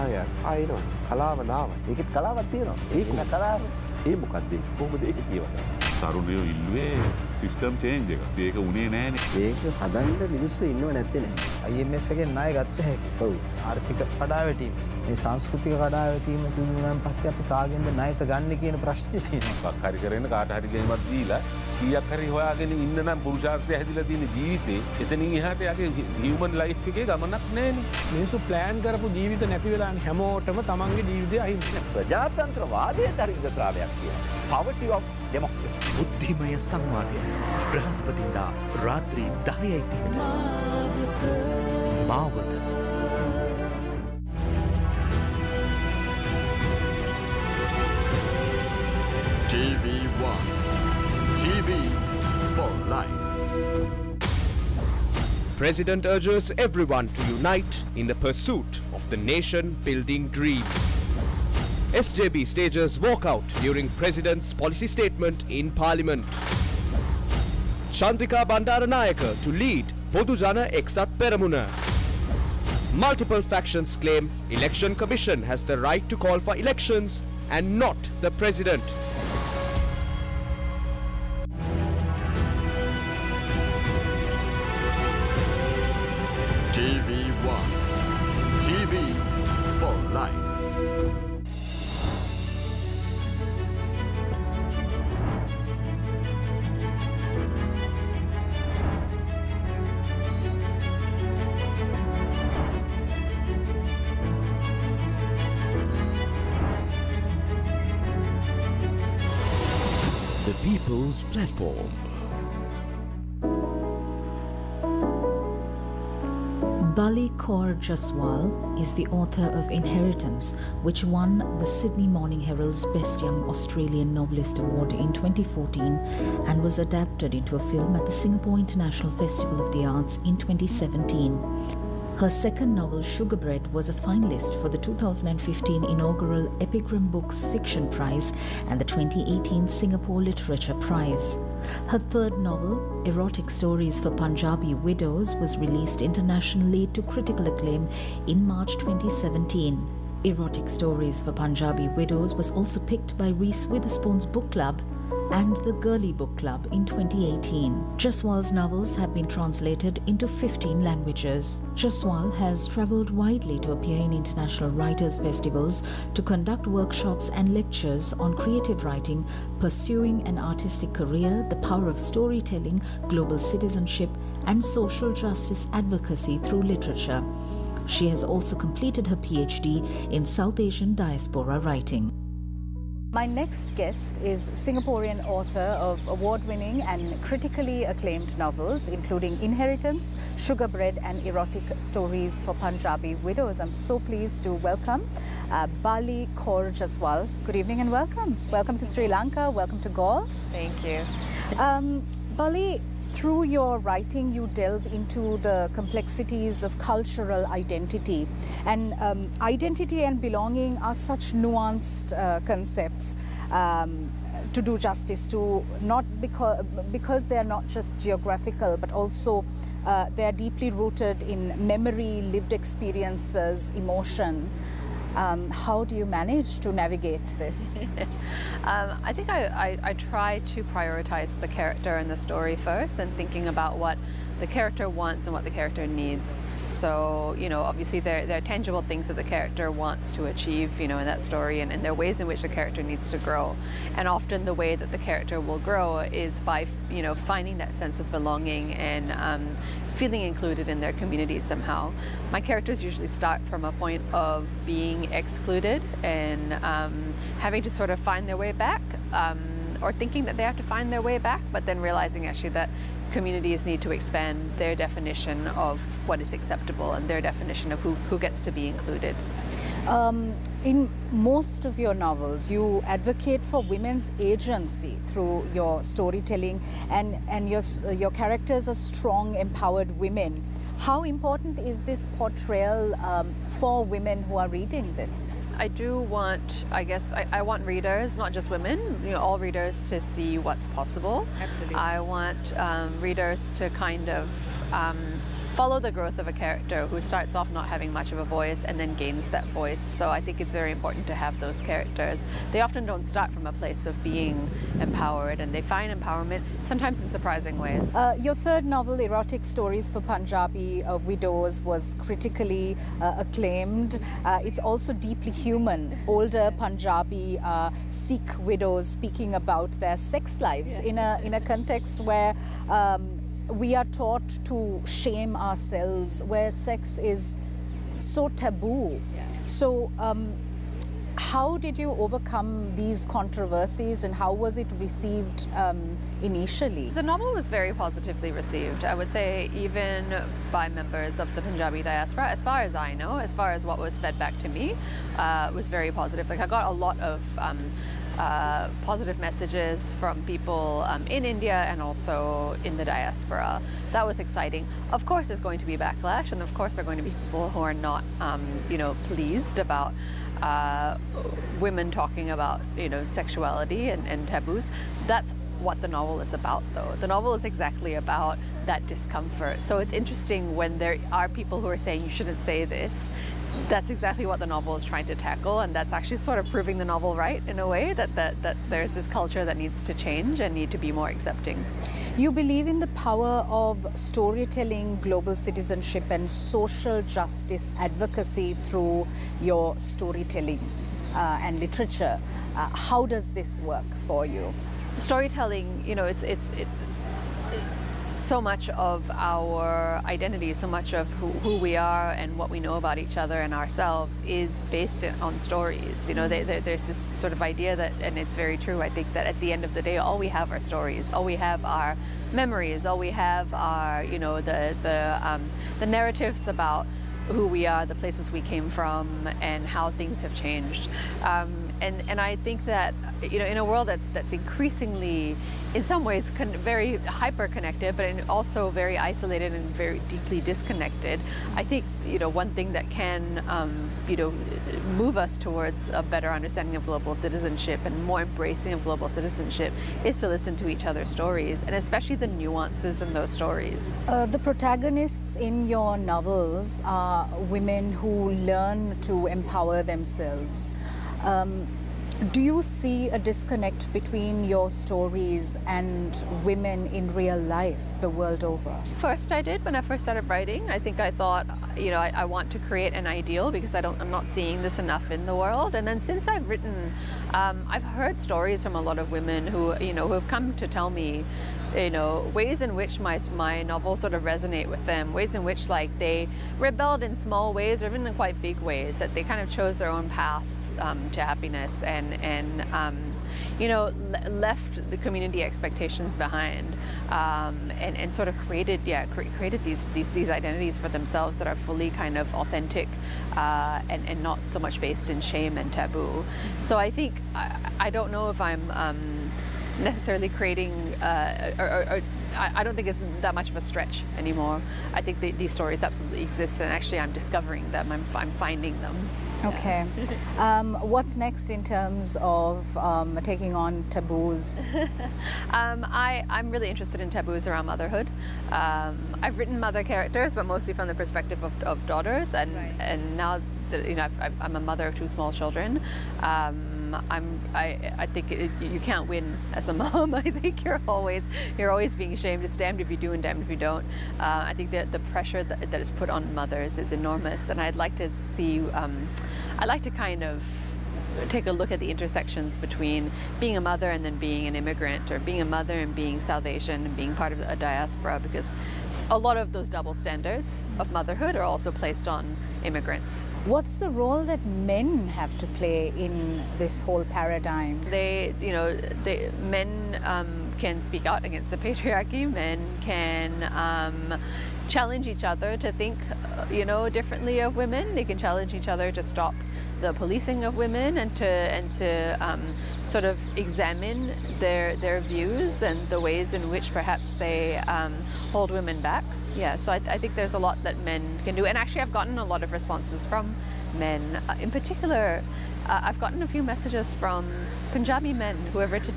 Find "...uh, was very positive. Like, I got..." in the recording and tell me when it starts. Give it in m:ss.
5:45.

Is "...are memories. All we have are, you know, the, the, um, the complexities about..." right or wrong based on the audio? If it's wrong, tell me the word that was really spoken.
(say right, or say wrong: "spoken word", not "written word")
wrong: "narratives", not "complexities".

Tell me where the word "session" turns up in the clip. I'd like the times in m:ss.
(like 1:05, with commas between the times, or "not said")
not said.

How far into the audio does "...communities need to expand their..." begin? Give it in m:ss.
4:23.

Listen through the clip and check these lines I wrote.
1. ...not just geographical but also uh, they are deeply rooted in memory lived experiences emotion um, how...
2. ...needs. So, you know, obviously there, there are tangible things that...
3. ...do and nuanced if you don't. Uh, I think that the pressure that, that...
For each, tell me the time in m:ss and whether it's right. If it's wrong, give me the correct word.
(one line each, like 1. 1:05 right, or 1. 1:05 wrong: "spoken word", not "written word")
1. 3:37 right
2. 3:55 right
3. 8:52 wrong: "damned", not "nuanced".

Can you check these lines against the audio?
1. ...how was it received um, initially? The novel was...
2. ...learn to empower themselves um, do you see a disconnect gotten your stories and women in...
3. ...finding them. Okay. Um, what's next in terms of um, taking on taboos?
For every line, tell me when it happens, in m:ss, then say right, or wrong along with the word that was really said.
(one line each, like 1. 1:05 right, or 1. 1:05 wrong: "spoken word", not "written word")
1. 5:34 right
2. 7:28 wrong: "between", not "gotten"
3. 8:28 right.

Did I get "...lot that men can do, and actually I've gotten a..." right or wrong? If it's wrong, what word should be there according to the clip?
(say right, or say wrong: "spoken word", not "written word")
right.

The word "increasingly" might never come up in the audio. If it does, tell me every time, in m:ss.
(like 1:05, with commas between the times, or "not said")
7:04.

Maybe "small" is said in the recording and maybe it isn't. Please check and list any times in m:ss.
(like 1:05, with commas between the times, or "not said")
7:57, 8:45.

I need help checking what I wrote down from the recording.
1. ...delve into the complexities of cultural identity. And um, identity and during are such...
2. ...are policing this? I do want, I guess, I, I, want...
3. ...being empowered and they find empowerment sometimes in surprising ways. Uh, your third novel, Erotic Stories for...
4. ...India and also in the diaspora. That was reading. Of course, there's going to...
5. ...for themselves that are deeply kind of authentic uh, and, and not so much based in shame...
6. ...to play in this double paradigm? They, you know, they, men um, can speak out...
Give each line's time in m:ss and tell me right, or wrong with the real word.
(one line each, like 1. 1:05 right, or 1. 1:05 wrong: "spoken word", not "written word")
1. 3:24 wrong: "belonging", not "during"
2. 4:44 wrong: "reading", not "policing"
3. 5:04 right
4. 5:51 wrong: "exciting", not "reading"
5. 8:10 wrong: "fully", not "deeply"
6. 9:15 wrong: "whole", not "double".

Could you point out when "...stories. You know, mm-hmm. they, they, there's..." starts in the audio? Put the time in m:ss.
6:45.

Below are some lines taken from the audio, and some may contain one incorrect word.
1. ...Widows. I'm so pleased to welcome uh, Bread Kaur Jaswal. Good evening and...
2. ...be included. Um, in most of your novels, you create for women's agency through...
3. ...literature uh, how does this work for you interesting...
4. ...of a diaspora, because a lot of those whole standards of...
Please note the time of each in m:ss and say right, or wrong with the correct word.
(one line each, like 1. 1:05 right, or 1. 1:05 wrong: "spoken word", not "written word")
1. 3:13 wrong: "Balli", not "Bread"
2. 4:28 wrong: "advocate", not "create"
3. 6:31 wrong: "storytelling", not "interesting"
4. 9:07 wrong: "double", not "whole".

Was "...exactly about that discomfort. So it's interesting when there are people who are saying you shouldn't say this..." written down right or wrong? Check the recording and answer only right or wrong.
right.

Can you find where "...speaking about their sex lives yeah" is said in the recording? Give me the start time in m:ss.
5:18.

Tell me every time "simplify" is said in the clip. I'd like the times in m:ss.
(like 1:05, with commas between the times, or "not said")
not said.